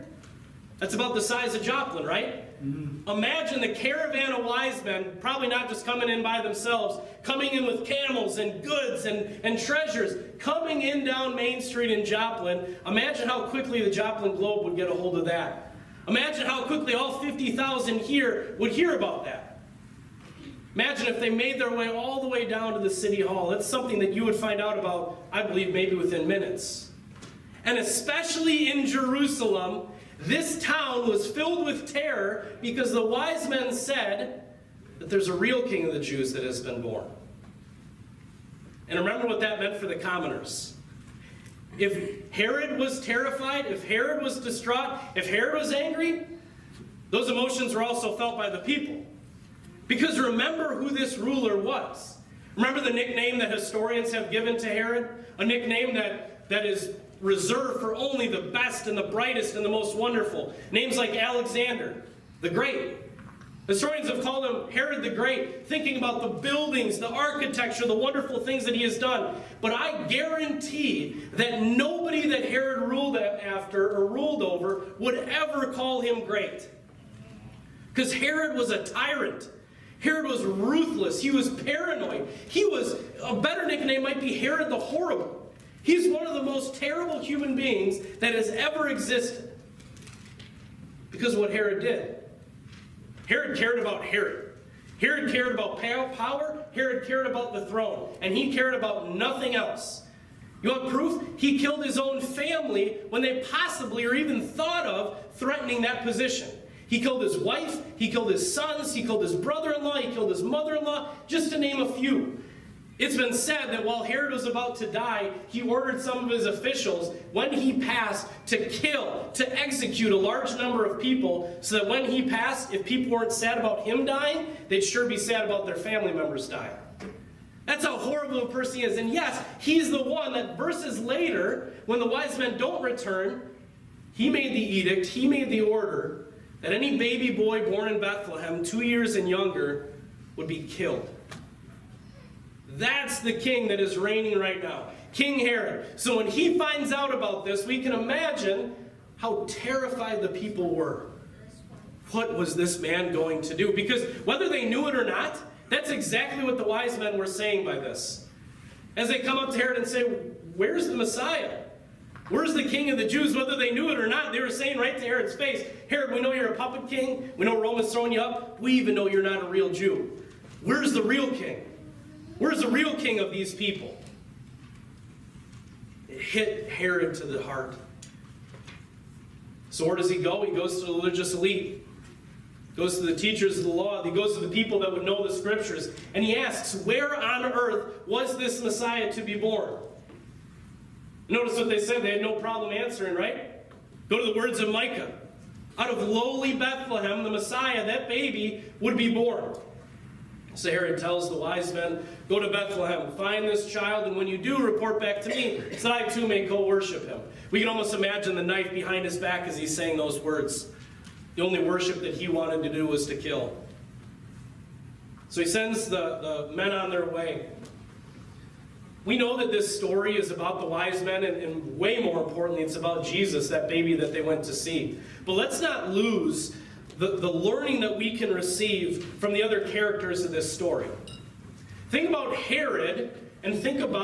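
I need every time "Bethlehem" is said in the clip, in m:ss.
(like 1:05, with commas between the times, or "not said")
2:17, 3:16, 3:22.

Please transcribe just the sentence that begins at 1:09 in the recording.
But I guarantee that nobody that Herod ruled after or ruled over would ever call him great.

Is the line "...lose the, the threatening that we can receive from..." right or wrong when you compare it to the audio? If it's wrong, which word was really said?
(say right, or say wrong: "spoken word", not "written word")
wrong: "learning", not "threatening".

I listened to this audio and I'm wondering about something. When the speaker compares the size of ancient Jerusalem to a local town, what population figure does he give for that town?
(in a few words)
50,000.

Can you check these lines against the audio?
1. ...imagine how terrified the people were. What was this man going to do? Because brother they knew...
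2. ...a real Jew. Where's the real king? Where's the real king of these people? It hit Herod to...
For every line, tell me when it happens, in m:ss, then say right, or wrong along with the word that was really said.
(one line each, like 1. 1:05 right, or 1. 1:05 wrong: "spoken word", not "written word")
1. 2:27 wrong: "whether", not "brother"
2. 2:49 right.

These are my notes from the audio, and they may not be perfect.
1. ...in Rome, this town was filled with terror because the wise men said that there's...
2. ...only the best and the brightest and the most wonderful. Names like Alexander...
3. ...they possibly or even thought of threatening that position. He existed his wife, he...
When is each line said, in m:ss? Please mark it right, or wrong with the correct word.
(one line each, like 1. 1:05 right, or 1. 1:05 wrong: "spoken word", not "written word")
1. 0:28 wrong: "Jerusalem", not "Rome"
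2. 0:57 right
3. 1:43 wrong: "killed", not "existed".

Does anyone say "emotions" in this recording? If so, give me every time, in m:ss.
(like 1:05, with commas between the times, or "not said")
0:47.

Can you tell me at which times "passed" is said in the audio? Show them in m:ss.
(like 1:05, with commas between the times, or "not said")
1:57, 2:02.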